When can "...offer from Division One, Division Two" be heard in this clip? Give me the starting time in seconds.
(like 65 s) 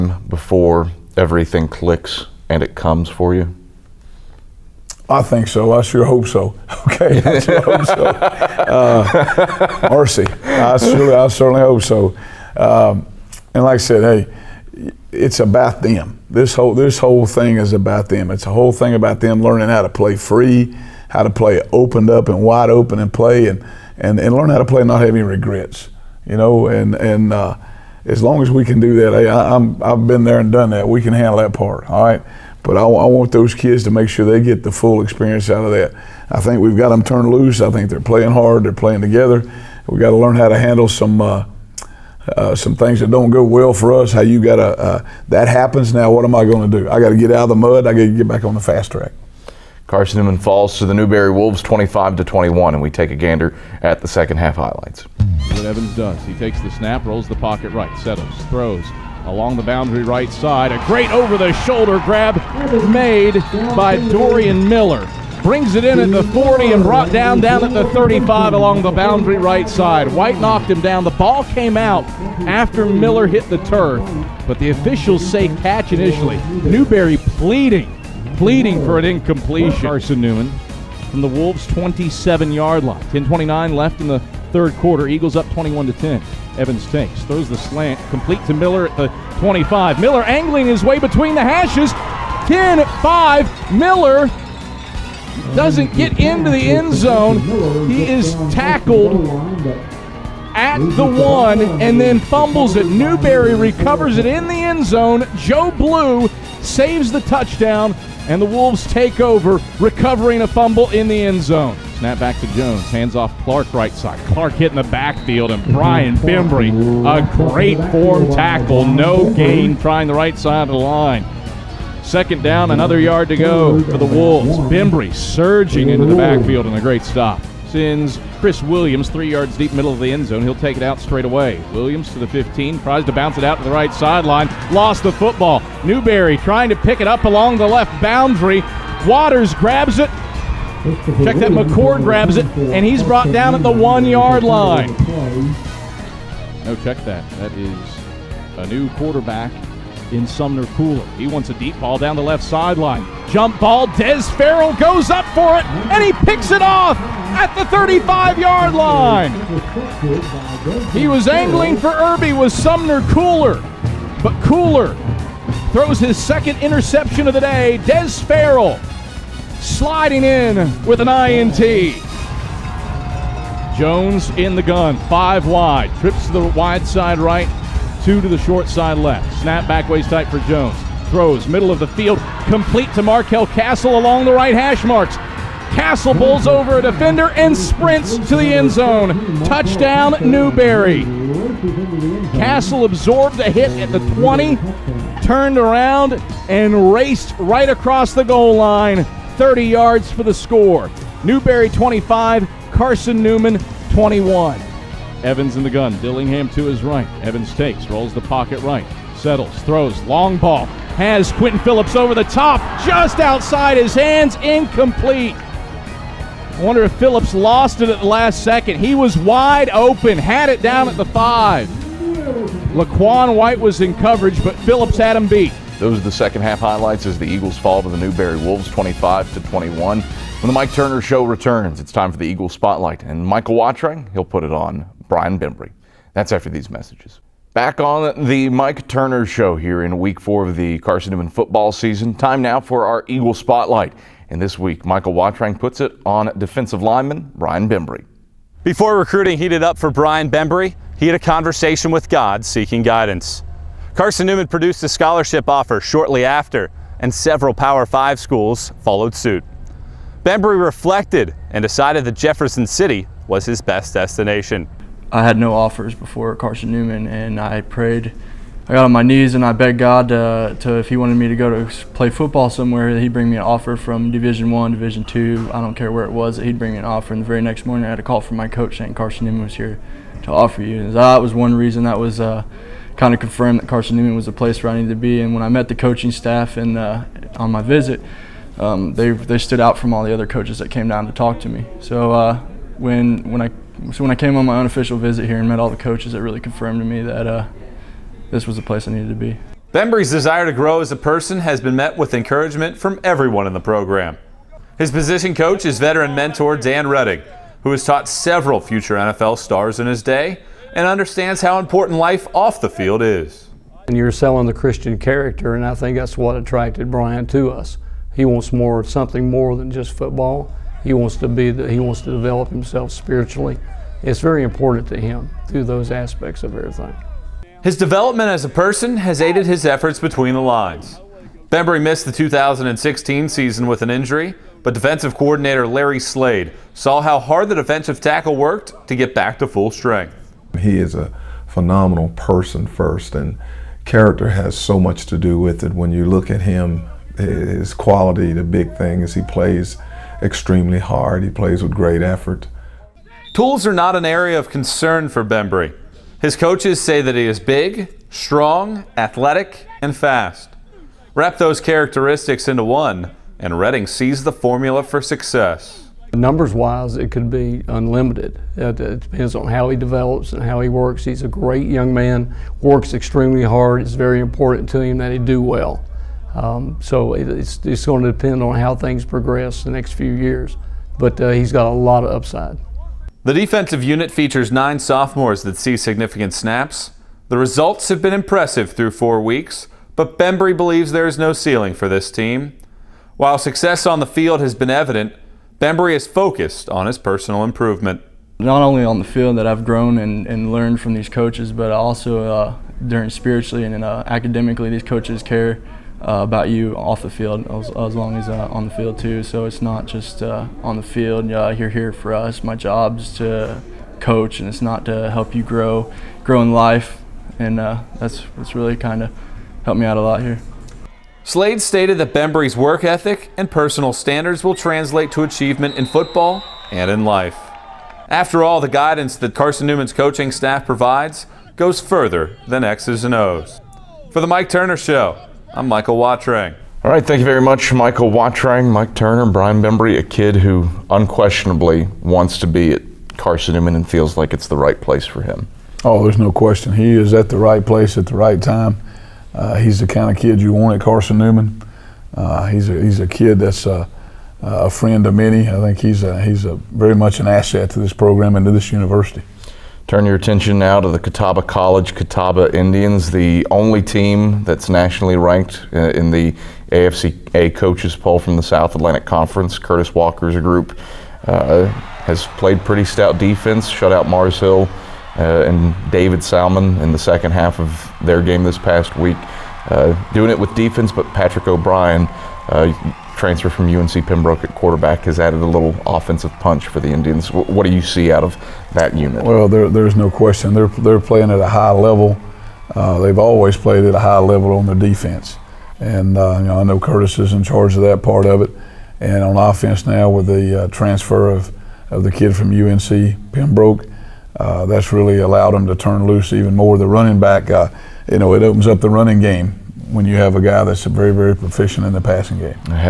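273 s.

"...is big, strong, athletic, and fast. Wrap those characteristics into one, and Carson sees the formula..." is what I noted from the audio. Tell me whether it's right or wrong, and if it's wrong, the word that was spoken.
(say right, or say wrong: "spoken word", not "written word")
wrong: "Redding", not "Carson".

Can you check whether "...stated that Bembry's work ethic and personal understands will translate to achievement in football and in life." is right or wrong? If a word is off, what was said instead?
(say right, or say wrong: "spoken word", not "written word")
wrong: "standards", not "understands".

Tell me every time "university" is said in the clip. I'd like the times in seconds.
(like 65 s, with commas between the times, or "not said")
458 s.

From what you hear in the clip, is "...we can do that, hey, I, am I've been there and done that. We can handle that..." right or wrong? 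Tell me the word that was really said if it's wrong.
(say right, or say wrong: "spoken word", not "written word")
right.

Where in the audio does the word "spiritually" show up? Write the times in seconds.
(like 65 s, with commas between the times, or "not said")
322 s, 403 s.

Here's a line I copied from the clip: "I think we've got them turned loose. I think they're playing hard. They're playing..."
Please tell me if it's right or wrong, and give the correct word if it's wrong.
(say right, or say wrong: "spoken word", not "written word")
right.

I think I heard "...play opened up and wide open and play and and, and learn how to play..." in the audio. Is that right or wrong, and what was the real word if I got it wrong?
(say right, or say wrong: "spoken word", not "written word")
right.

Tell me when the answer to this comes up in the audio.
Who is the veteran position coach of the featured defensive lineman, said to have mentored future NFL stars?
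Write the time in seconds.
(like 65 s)
306 s.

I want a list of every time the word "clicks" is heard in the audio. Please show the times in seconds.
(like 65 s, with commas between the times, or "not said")
1 s.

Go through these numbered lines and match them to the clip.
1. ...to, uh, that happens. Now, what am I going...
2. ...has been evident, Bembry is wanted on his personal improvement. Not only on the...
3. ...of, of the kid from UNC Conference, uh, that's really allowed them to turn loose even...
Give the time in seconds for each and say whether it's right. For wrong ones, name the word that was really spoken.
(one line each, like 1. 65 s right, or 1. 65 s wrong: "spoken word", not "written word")
1. 44 s right
2. 394 s wrong: "focused", not "wanted"
3. 501 s wrong: "Pembroke", not "Conference".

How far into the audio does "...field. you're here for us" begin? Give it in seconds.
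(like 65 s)
410 s.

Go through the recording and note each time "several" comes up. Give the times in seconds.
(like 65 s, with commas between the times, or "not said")
257 s, 308 s.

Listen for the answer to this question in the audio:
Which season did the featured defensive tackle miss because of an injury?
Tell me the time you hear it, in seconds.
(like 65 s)
332 s.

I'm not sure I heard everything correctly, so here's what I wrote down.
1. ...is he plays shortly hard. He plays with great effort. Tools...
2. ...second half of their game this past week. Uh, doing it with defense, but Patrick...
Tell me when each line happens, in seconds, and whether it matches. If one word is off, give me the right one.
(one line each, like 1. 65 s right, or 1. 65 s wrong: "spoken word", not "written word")
1. 349 s wrong: "extremely", not "shortly"
2. 476 s right.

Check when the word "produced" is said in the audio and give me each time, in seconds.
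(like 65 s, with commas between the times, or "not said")
254 s.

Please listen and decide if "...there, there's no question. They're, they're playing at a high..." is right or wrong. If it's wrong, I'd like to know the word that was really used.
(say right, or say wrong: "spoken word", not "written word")
right.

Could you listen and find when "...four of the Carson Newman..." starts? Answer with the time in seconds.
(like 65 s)
240 s.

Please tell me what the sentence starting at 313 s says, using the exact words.
And you're selling the Christian character, and I think that's what attracted Brian to us.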